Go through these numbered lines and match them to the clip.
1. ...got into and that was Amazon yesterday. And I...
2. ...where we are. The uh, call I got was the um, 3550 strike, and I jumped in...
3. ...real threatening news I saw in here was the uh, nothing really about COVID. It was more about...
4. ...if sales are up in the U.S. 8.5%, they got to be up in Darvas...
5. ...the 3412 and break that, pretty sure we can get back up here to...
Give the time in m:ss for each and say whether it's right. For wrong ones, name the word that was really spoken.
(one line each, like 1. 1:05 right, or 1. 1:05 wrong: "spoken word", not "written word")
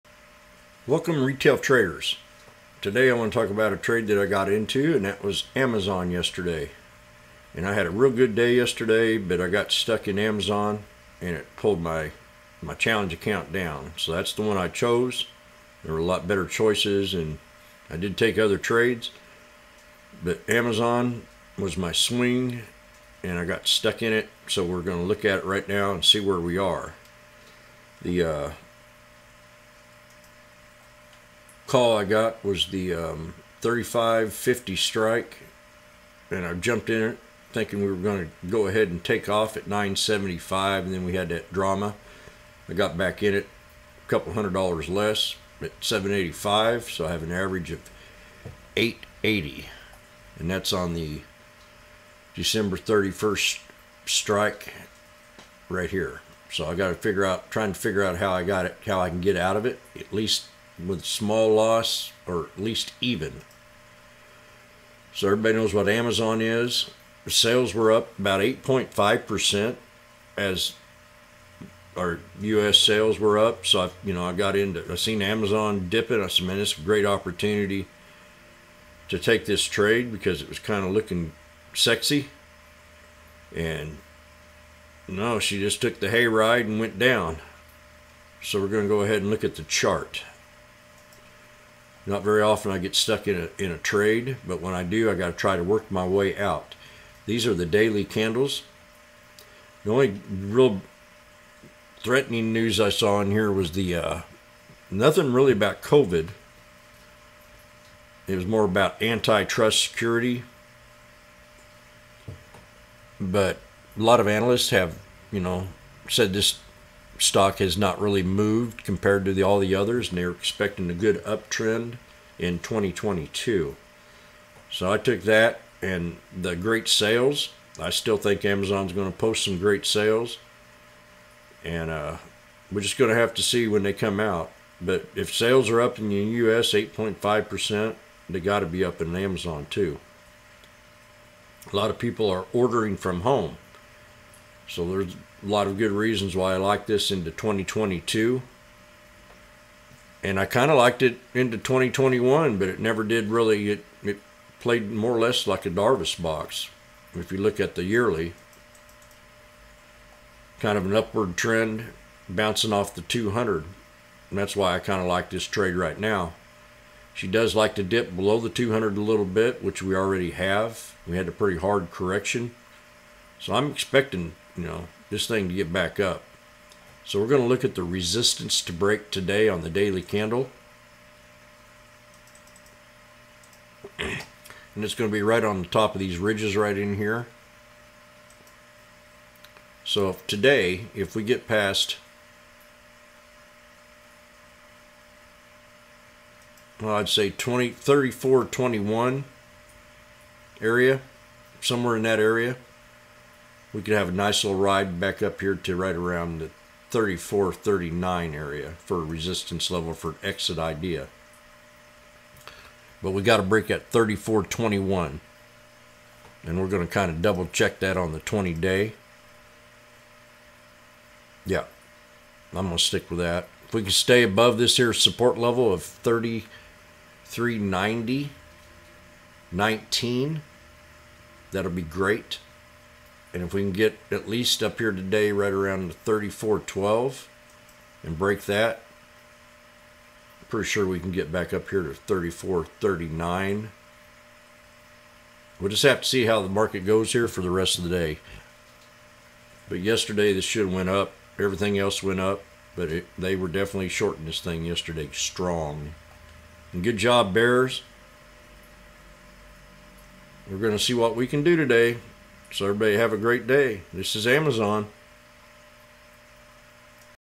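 1. 0:04 right
2. 0:26 right
3. 1:40 right
4. 2:15 wrong: "Amazon", not "Darvas"
5. 3:55 right.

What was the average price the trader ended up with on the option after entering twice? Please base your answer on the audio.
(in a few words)
880.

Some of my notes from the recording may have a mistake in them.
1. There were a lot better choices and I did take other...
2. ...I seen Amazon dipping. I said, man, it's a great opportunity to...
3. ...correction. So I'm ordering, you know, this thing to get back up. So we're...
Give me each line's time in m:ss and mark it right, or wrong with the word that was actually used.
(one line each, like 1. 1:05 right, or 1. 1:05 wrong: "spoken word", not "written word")
1. 0:15 right
2. 1:14 right
3. 2:51 wrong: "expecting", not "ordering".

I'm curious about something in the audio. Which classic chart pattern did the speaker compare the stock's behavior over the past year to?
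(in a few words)
Darvas box.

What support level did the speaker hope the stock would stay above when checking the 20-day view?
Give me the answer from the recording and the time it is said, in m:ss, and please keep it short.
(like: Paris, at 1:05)
3390, at 3:45.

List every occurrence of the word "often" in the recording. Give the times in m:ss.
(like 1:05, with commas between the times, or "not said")
1:32.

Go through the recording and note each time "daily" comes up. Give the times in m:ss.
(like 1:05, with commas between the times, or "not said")
1:37, 2:59.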